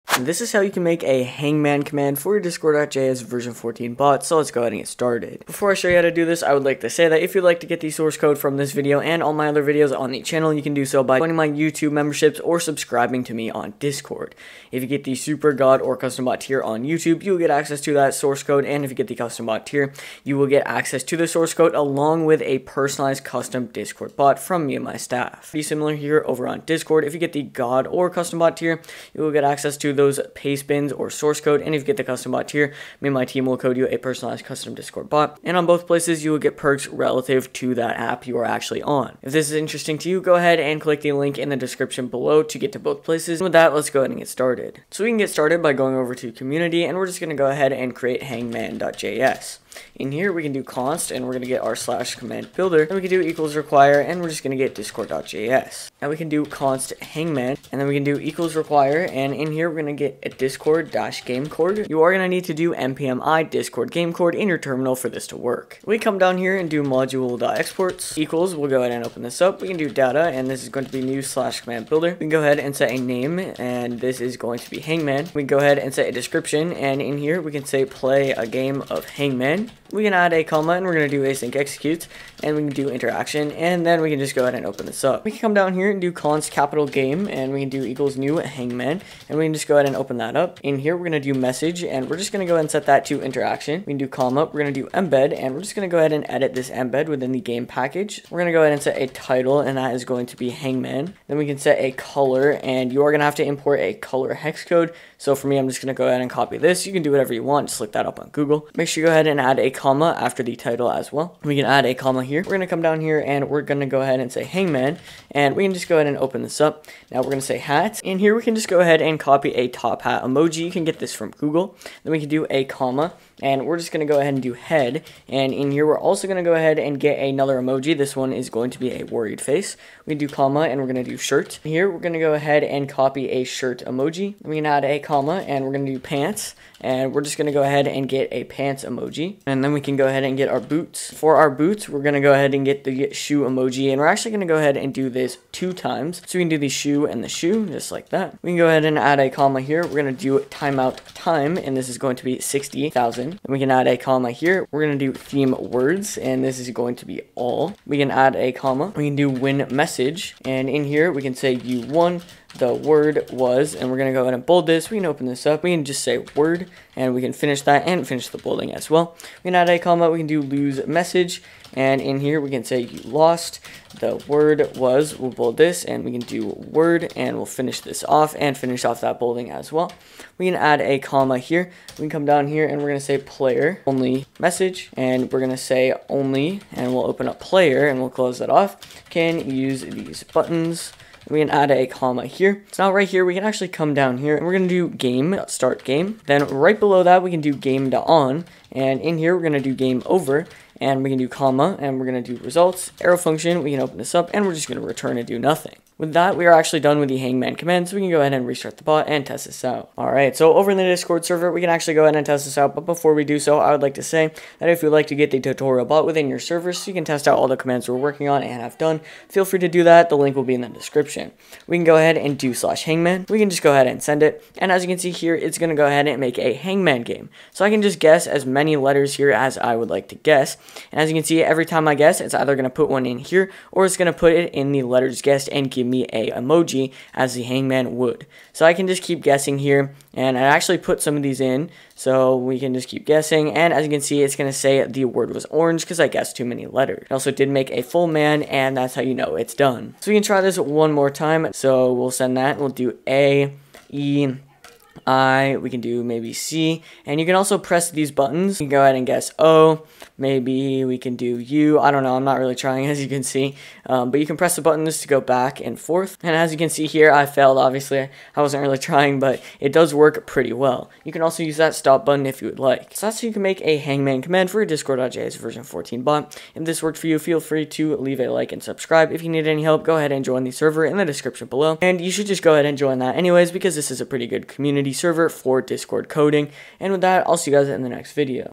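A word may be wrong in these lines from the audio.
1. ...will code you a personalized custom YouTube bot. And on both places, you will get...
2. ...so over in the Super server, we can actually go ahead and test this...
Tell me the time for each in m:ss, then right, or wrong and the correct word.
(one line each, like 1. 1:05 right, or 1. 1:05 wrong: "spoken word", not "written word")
1. 0:33 wrong: "Discord", not "YouTube"
2. 3:30 wrong: "Discord", not "Super".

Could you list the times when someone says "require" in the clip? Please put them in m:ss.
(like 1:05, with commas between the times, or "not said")
0:53, 0:58.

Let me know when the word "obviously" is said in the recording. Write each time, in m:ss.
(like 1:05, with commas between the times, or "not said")
4:27.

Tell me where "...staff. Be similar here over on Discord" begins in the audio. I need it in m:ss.
0:24.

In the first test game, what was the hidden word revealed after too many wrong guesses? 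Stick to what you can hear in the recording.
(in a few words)
orange.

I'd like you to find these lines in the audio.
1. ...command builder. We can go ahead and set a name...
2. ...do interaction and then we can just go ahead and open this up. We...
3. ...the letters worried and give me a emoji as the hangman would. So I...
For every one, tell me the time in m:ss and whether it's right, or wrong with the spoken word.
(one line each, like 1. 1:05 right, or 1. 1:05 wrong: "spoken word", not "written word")
1. 1:11 right
2. 1:22 right
3. 3:54 wrong: "guessed", not "worried".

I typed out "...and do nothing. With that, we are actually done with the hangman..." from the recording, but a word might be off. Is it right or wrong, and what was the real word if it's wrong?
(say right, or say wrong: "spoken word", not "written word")
right.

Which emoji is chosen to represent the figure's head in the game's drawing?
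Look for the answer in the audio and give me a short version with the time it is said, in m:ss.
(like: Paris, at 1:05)
worried face, at 2:09.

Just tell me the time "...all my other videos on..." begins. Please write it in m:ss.
0:09.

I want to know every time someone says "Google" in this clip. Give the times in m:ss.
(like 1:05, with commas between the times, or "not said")
1:48, 2:01.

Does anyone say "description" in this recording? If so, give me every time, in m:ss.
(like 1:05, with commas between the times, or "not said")
0:41, 1:16, 3:40, 4:41.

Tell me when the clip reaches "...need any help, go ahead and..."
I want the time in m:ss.
4:39.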